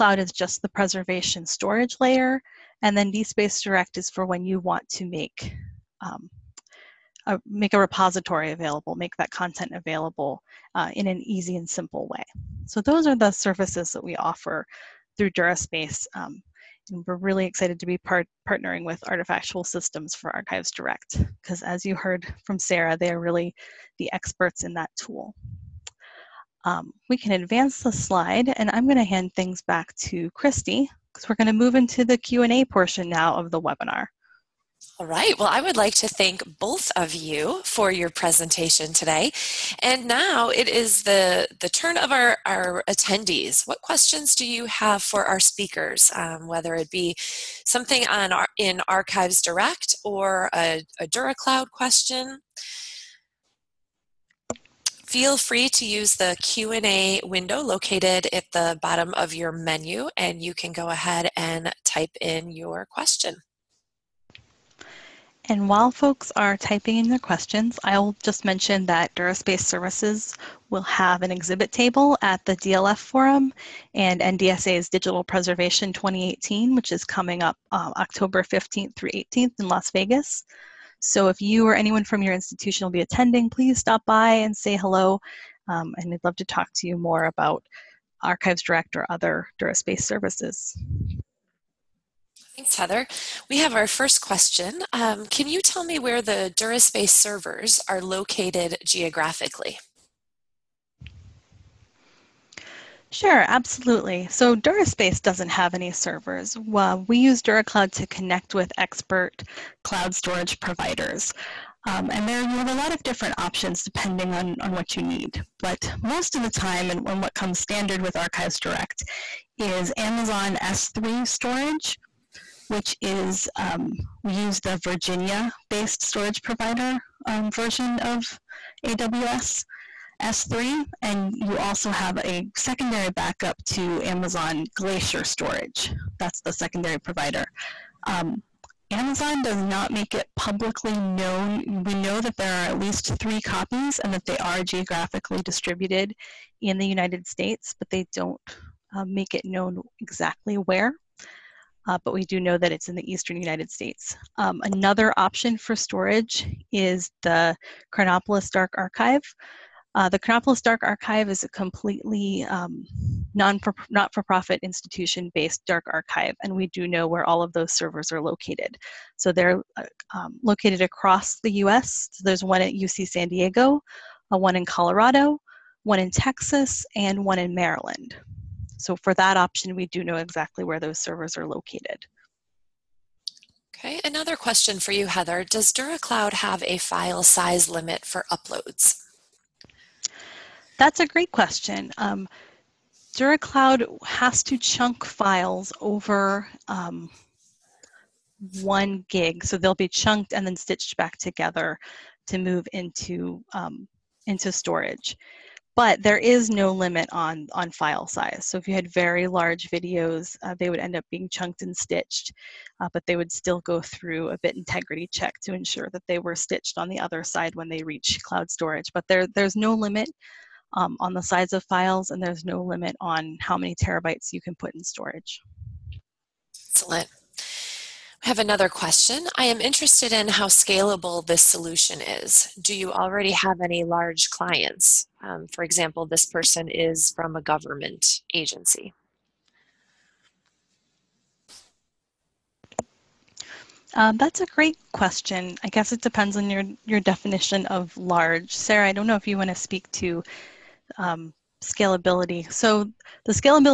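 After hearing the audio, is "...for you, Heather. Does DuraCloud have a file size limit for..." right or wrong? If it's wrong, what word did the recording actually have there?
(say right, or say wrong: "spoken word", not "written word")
right.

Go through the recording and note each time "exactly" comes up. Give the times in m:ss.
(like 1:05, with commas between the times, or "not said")
2:29, 3:00.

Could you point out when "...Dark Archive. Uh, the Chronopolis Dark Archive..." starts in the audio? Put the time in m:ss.
2:38.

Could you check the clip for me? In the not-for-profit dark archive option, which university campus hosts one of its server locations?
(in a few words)
UC San Diego.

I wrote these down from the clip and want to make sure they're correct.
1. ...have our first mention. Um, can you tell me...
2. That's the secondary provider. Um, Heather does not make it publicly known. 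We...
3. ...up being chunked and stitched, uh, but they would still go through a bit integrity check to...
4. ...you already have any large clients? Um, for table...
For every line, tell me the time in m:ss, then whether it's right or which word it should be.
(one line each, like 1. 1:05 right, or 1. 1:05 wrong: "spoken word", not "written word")
1. 1:33 wrong: "question", not "mention"
2. 2:16 wrong: "Amazon", not "Heather"
3. 3:30 right
4. 3:52 wrong: "example", not "table".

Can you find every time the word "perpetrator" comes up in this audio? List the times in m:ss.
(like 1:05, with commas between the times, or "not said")
not said.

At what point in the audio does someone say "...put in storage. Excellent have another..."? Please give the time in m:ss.
3:44.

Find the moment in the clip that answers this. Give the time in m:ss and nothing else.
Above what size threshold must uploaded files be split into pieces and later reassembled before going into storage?
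3:18.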